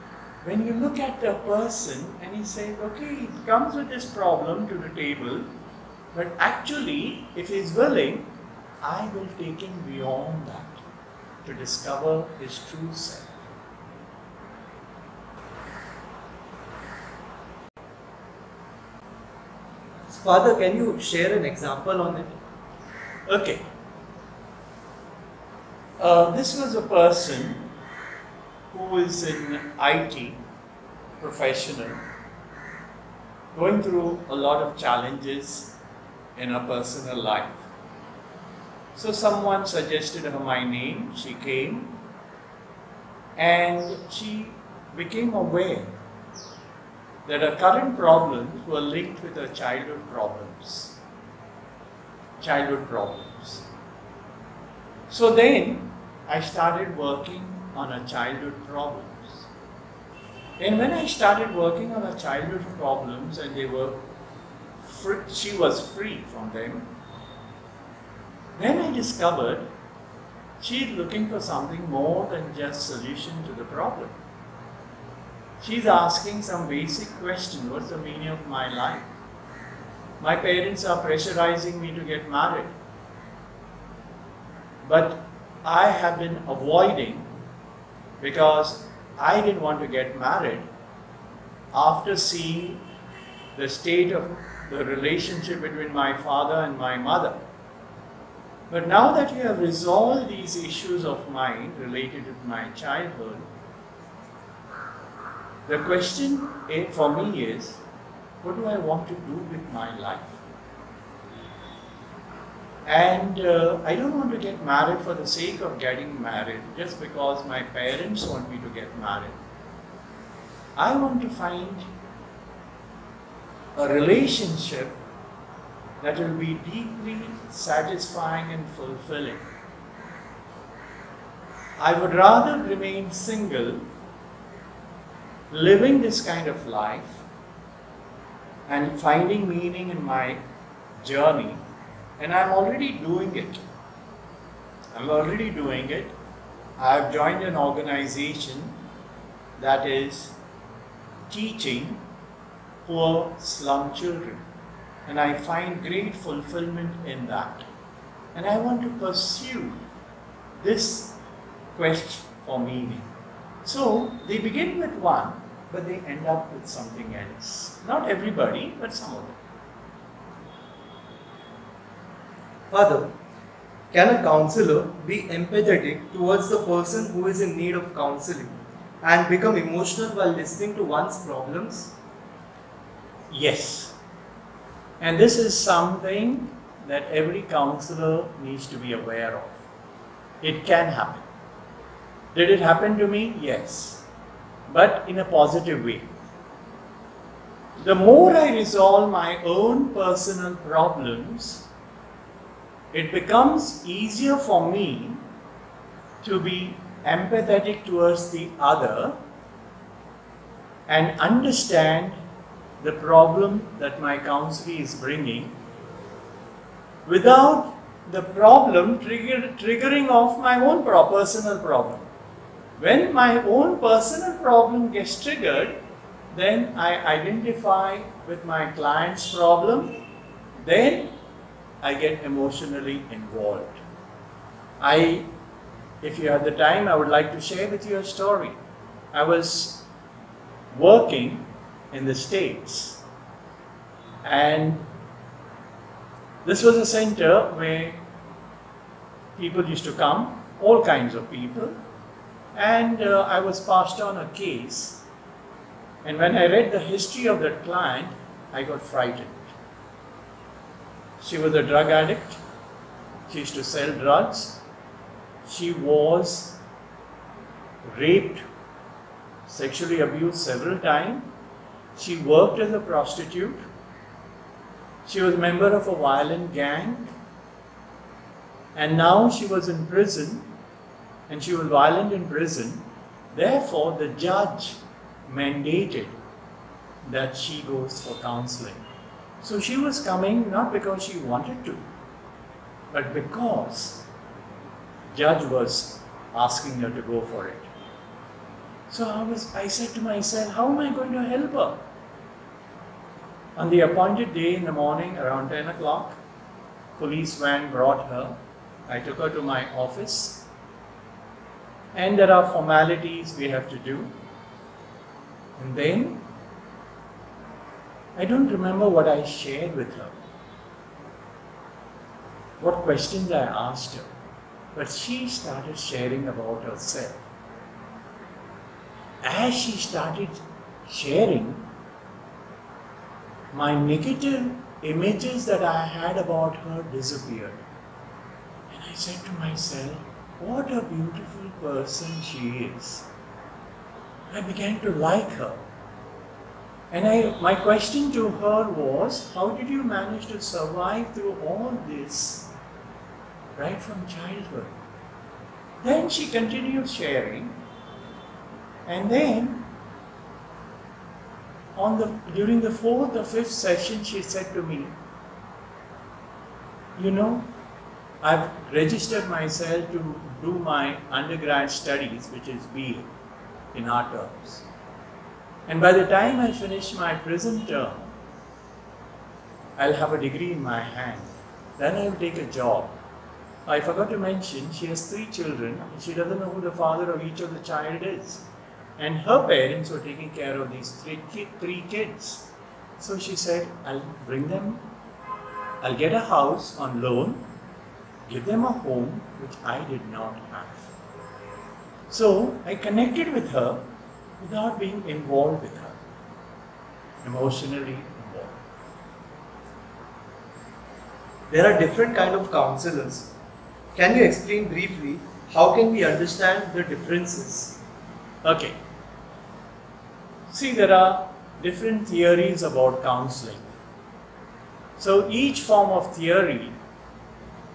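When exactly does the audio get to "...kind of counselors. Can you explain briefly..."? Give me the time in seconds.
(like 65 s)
412 s.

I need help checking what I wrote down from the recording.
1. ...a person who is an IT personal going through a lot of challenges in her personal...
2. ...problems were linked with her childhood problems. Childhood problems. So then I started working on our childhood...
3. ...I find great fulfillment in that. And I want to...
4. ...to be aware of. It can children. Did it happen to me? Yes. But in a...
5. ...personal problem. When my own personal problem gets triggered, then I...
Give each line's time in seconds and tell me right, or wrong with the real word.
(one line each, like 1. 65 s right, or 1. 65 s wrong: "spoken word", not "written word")
1. 26 s wrong: "professional", not "personal"
2. 47 s right
3. 155 s right
4. 188 s wrong: "happen", not "children"
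5. 220 s right.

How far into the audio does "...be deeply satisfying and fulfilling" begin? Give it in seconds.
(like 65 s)
126 s.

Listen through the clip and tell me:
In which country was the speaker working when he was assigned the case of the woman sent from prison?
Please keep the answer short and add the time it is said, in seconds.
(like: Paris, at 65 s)
the States, at 242 s.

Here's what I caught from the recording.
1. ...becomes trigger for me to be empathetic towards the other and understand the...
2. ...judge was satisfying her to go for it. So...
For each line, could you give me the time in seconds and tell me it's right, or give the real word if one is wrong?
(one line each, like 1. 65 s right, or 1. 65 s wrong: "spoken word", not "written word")
1. 203 s wrong: "easier", not "trigger"
2. 295 s wrong: "asking", not "satisfying".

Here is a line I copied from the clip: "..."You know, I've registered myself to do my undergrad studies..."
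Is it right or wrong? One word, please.
right.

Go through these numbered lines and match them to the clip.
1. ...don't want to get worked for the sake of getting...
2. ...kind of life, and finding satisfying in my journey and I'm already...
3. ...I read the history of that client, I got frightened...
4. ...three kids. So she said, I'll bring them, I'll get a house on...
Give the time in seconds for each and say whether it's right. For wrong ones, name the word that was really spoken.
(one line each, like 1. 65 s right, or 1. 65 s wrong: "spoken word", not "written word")
1. 113 s wrong: "married", not "worked"
2. 136 s wrong: "meaning", not "satisfying"
3. 256 s right
4. 391 s right.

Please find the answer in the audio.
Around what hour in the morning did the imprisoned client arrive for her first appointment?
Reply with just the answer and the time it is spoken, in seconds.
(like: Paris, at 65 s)
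10 o'clock, at 305 s.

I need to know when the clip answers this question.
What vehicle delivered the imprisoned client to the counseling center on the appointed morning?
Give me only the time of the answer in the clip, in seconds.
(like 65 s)
306 s.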